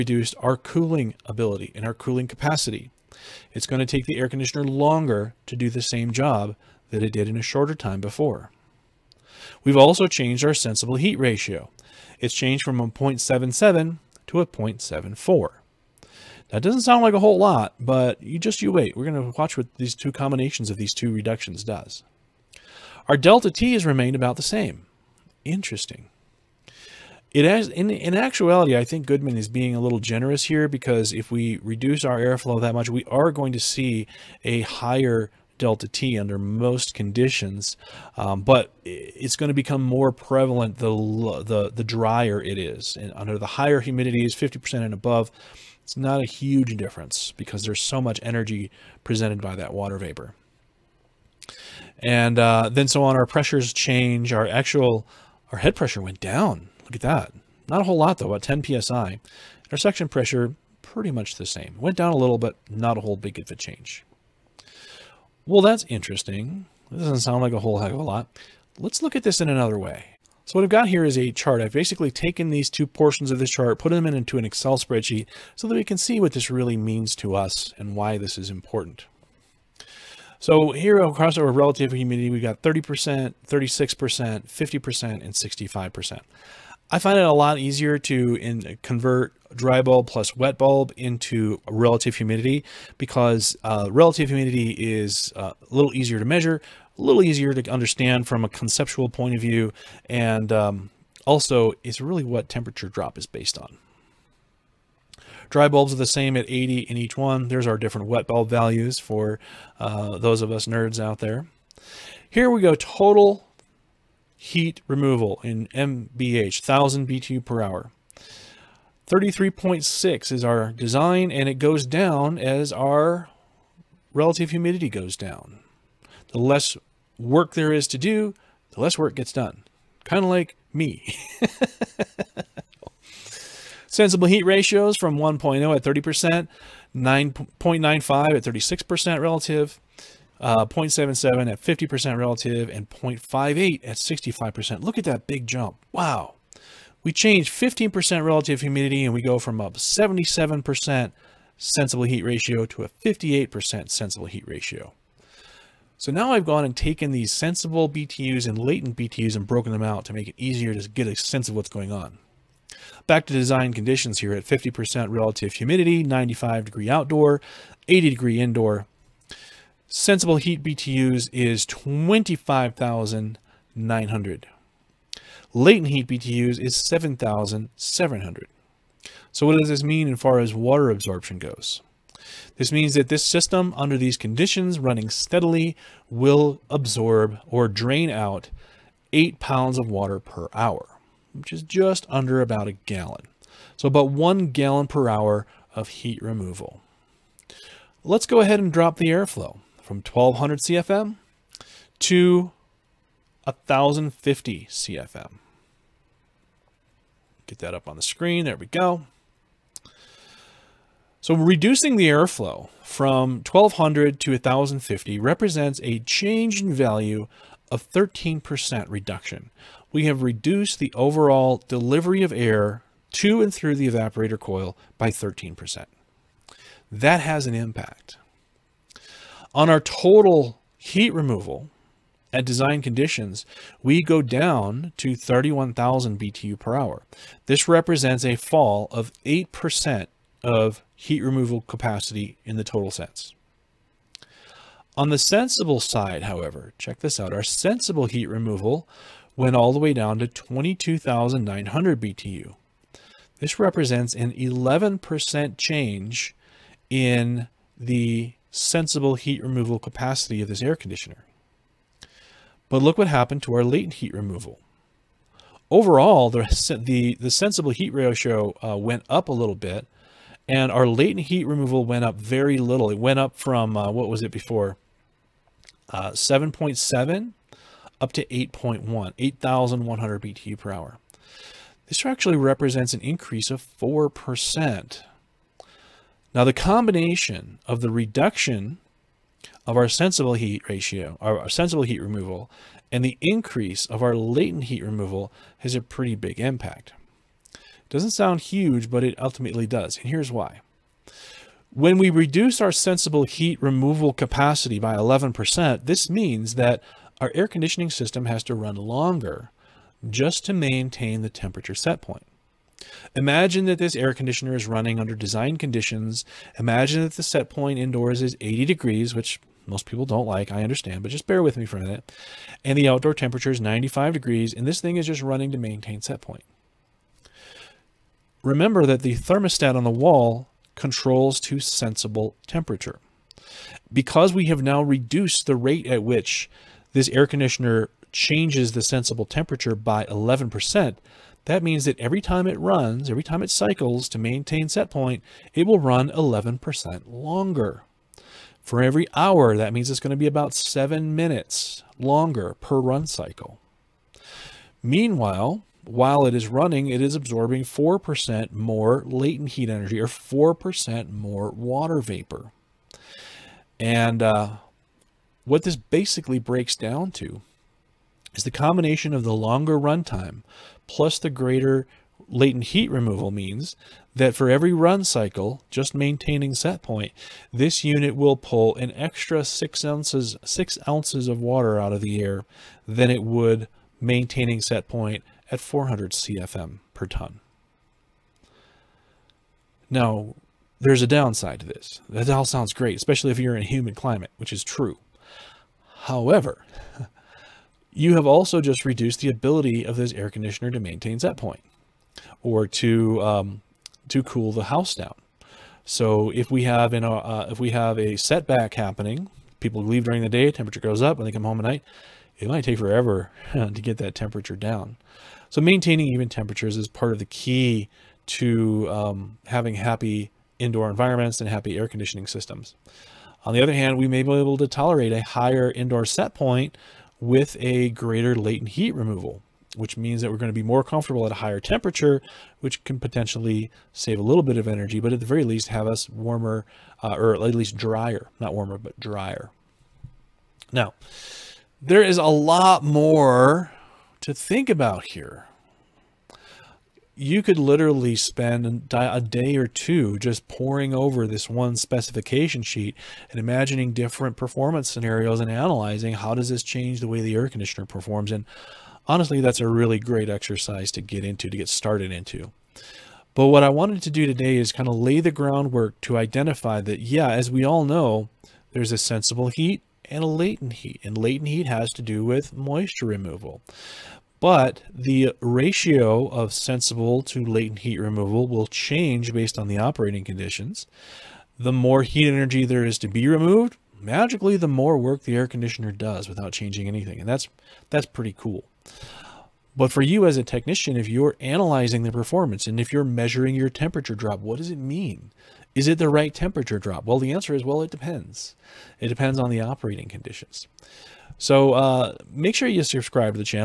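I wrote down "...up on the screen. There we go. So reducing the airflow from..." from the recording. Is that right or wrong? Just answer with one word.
right.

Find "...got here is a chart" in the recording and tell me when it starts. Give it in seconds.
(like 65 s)
70 s.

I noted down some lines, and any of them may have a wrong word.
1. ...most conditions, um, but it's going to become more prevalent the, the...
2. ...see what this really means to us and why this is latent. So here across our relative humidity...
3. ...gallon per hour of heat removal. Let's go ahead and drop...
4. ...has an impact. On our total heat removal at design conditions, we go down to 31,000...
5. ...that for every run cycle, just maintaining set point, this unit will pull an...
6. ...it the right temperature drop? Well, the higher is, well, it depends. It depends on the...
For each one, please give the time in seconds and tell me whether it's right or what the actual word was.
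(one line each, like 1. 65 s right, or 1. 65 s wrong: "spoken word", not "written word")
1. 36 s right
2. 75 s wrong: "important", not "latent"
3. 194 s right
4. 227 s right
5. 374 s right
6. 495 s wrong: "answer", not "higher".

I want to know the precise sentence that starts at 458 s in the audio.
And honestly, that's a really great exercise to get into, to get started into.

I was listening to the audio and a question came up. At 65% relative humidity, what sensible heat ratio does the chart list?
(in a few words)
0.58.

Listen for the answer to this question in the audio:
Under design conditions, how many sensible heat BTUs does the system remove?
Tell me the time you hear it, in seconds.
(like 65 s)
171 s.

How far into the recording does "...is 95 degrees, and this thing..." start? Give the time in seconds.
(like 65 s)
323 s.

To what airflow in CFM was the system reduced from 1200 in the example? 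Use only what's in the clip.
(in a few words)
1050 CFM.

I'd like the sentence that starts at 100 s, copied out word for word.
And um, also, it's really what temperature drop is based on.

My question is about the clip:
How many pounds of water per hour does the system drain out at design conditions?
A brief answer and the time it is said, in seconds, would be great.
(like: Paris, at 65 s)
8 pounds, at 189 s.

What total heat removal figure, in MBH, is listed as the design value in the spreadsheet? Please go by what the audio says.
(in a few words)
33.6.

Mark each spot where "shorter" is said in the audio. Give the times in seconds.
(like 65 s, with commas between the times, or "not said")
7 s.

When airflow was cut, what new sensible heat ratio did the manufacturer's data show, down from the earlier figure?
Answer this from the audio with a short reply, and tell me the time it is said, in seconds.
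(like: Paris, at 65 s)
0.74, at 14 s.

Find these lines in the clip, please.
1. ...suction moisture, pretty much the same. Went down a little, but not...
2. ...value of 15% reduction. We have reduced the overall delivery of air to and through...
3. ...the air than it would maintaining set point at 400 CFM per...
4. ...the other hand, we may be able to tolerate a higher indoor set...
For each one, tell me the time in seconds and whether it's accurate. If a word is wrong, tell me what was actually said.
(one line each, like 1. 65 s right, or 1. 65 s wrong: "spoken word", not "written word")
1. 59 s wrong: "pressure", not "moisture"
2. 216 s wrong: "13", not "15"
3. 382 s right
4. 423 s right.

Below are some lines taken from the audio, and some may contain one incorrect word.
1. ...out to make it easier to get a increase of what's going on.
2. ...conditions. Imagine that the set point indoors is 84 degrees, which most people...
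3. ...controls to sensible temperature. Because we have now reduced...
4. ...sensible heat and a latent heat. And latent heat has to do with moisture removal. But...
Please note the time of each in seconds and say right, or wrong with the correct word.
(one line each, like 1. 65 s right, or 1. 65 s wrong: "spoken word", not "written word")
1. 159 s wrong: "sense", not "increase"
2. 315 s wrong: "80", not "84"
3. 330 s right
4. 468 s right.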